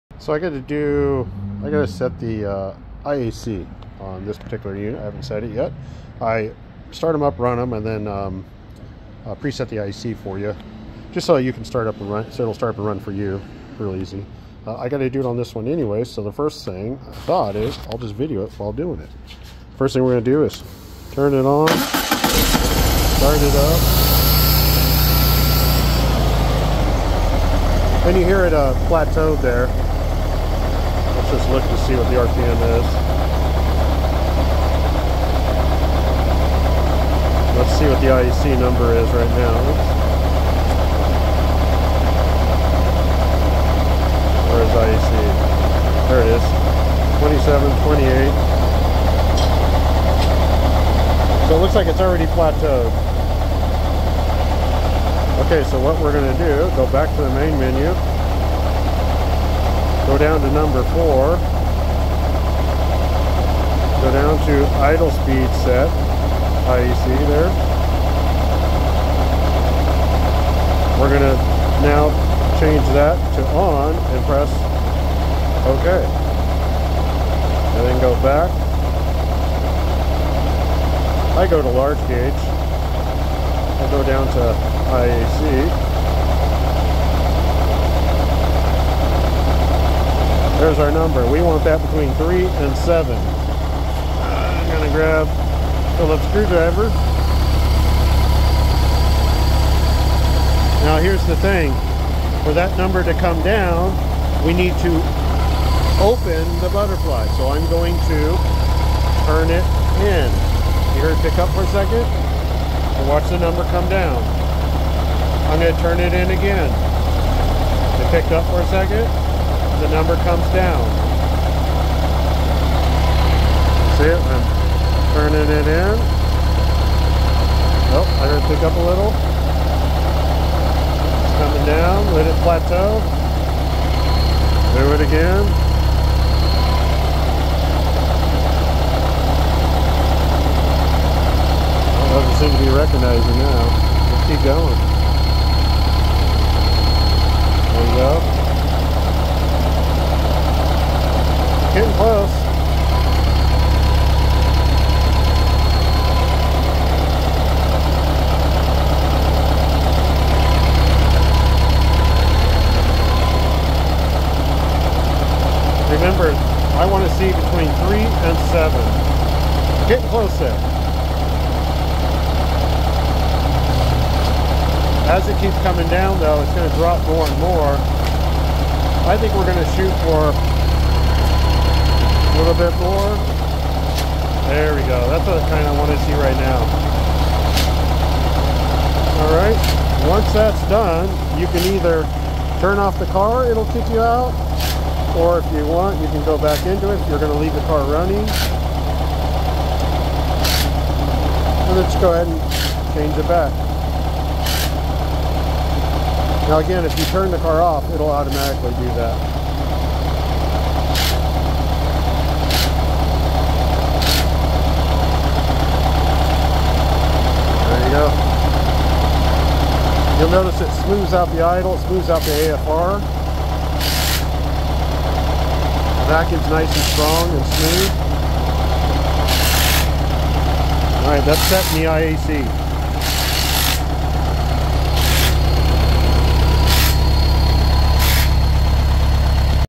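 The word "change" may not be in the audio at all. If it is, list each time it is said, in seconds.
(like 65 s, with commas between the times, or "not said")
72 s, 202 s.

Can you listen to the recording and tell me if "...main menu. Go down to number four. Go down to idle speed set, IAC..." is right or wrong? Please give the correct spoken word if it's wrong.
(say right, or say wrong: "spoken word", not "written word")
right.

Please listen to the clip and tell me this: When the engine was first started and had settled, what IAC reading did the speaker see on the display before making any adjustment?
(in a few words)
27, 28.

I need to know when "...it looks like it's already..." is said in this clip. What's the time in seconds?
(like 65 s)
51 s.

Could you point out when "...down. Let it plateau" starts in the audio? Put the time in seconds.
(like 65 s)
131 s.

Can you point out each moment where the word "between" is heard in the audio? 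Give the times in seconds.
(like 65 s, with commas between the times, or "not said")
91 s, 167 s.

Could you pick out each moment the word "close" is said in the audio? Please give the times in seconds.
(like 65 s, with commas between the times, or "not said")
151 s, 170 s.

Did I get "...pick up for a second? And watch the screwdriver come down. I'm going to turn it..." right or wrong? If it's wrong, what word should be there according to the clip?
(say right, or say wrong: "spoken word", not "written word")
wrong: "number", not "screwdriver".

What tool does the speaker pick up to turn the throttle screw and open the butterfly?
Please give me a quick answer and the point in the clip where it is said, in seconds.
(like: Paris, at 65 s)
Phillips screwdriver, at 95 s.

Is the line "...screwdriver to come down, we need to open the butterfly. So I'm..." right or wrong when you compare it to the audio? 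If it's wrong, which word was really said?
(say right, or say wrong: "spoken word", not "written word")
wrong: "number", not "screwdriver".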